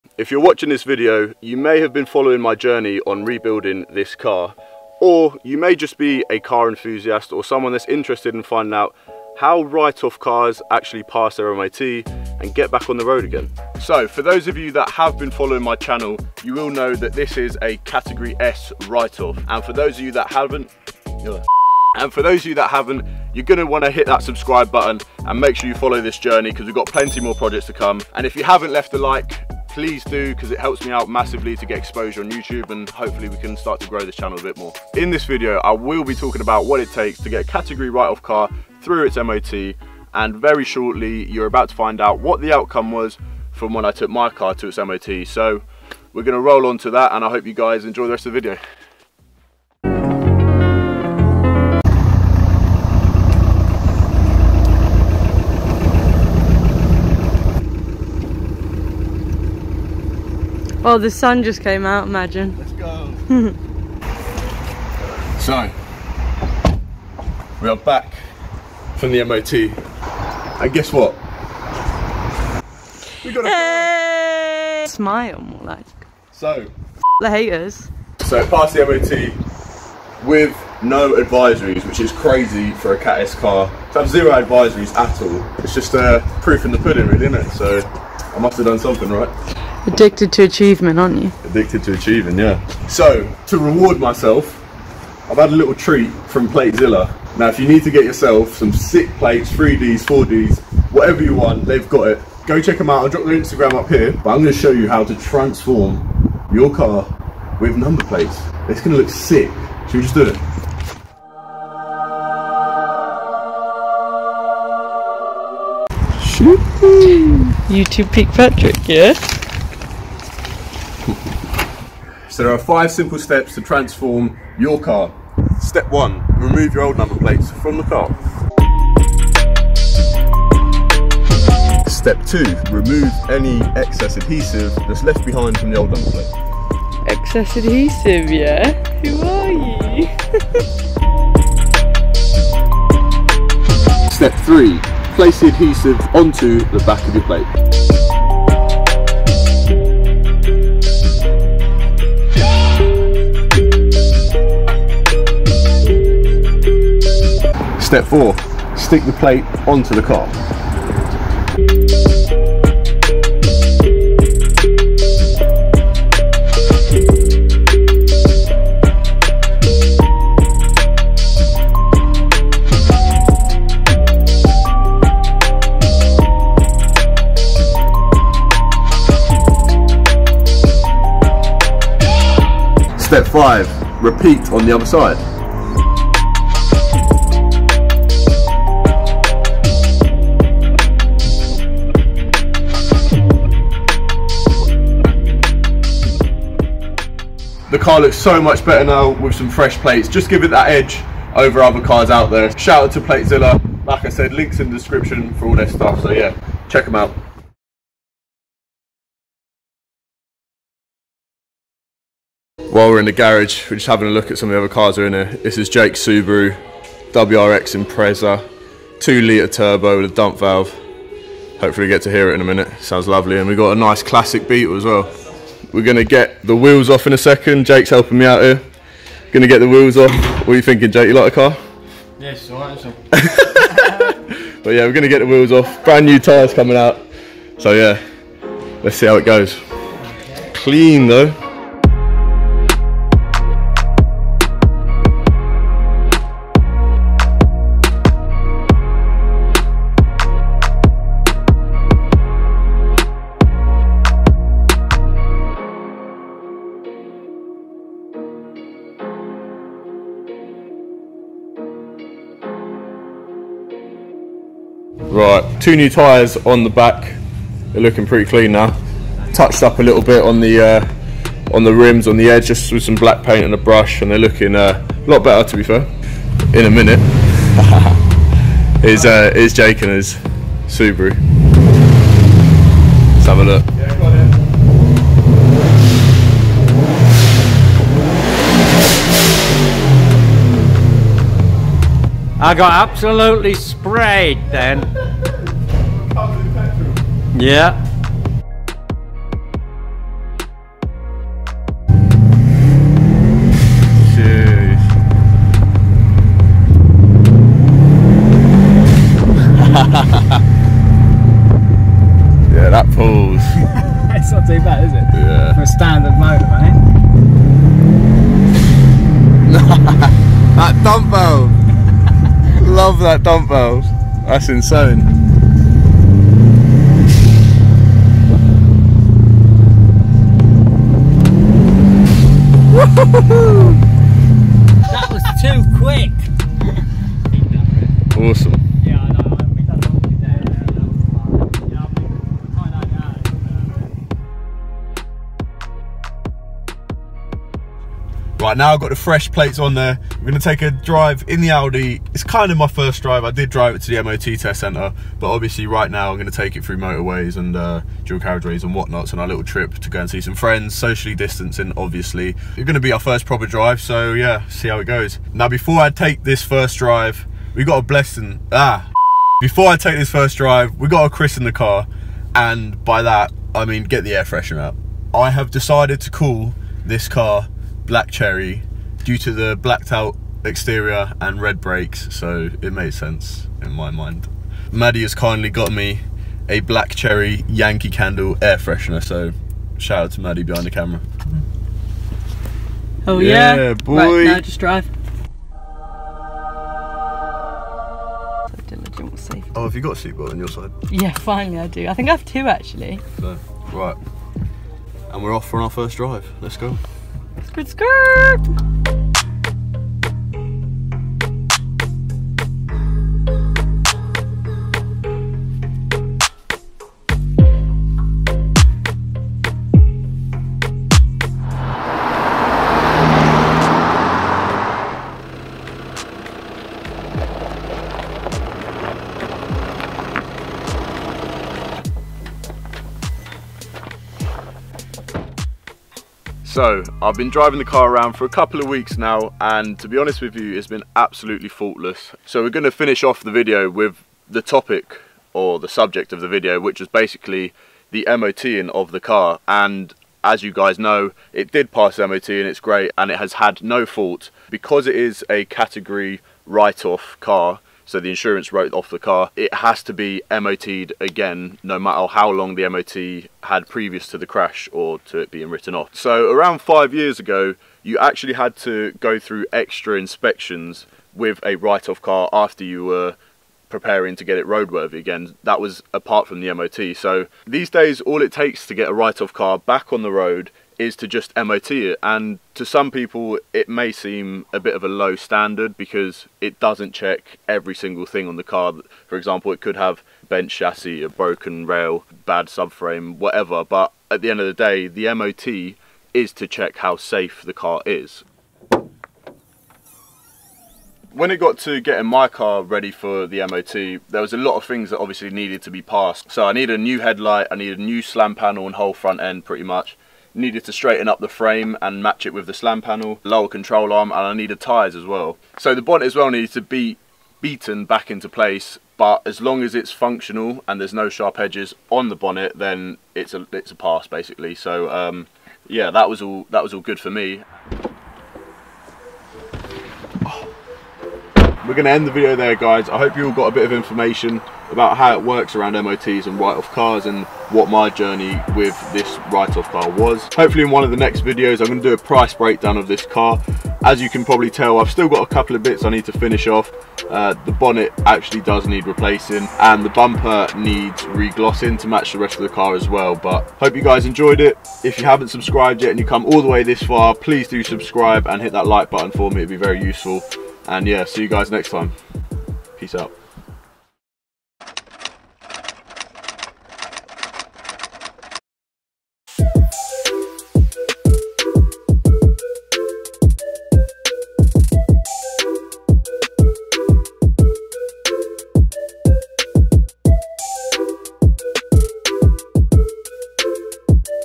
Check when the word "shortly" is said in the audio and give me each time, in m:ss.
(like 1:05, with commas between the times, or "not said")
0:40.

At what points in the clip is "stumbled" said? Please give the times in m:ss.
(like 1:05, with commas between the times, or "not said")
not said.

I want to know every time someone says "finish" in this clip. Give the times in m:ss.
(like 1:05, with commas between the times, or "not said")
7:22, 9:06.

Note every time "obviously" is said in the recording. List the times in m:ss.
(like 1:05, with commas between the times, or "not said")
5:55, 6:01, 8:24.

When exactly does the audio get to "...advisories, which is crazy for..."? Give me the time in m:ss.
1:21.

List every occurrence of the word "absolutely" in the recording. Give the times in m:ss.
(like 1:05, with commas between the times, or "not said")
4:52, 7:20.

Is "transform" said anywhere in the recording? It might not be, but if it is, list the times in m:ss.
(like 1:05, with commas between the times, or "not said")
1:45, 2:03.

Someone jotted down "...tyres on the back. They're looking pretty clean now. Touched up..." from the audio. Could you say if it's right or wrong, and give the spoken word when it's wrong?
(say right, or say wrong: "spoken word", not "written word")
right.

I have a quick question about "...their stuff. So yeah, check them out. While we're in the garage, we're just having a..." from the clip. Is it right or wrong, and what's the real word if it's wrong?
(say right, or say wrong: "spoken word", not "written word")
right.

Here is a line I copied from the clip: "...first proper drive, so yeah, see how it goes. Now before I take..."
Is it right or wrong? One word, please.
right.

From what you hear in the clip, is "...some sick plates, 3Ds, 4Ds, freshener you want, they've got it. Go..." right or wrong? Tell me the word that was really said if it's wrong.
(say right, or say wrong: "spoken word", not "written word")
wrong: "whatever", not "freshener".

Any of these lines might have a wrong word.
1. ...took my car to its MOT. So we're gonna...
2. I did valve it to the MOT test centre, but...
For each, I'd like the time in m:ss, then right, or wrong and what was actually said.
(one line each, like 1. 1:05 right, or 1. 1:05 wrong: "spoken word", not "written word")
1. 0:43 right
2. 5:53 wrong: "drive", not "valve".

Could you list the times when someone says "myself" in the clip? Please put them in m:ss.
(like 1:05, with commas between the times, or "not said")
1:33.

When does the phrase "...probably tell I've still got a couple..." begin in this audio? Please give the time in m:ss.
9:04.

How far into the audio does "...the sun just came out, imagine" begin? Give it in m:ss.
1:00.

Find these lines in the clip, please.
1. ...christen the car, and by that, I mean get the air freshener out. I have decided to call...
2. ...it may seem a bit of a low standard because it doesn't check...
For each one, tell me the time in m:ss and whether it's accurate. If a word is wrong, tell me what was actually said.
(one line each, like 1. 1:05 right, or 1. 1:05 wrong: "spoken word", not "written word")
1. 6:11 right
2. 8:03 right.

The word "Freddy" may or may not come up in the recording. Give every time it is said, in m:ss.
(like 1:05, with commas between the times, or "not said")
not said.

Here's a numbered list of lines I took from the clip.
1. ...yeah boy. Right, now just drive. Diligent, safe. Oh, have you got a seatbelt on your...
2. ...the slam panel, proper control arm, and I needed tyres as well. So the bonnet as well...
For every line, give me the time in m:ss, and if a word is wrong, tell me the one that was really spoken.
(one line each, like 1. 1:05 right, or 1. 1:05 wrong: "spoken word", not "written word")
1. 6:33 right
2. 8:32 wrong: "lower", not "proper".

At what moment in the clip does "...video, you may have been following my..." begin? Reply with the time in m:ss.
0:00.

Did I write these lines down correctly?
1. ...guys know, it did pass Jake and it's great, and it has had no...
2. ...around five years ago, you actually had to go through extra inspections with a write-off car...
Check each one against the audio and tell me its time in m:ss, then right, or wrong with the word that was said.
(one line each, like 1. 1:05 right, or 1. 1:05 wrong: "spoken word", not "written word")
1. 7:30 wrong: "MOT", not "Jake"
2. 7:46 right.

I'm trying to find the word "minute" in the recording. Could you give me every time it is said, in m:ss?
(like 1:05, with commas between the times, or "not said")
3:42, 4:36.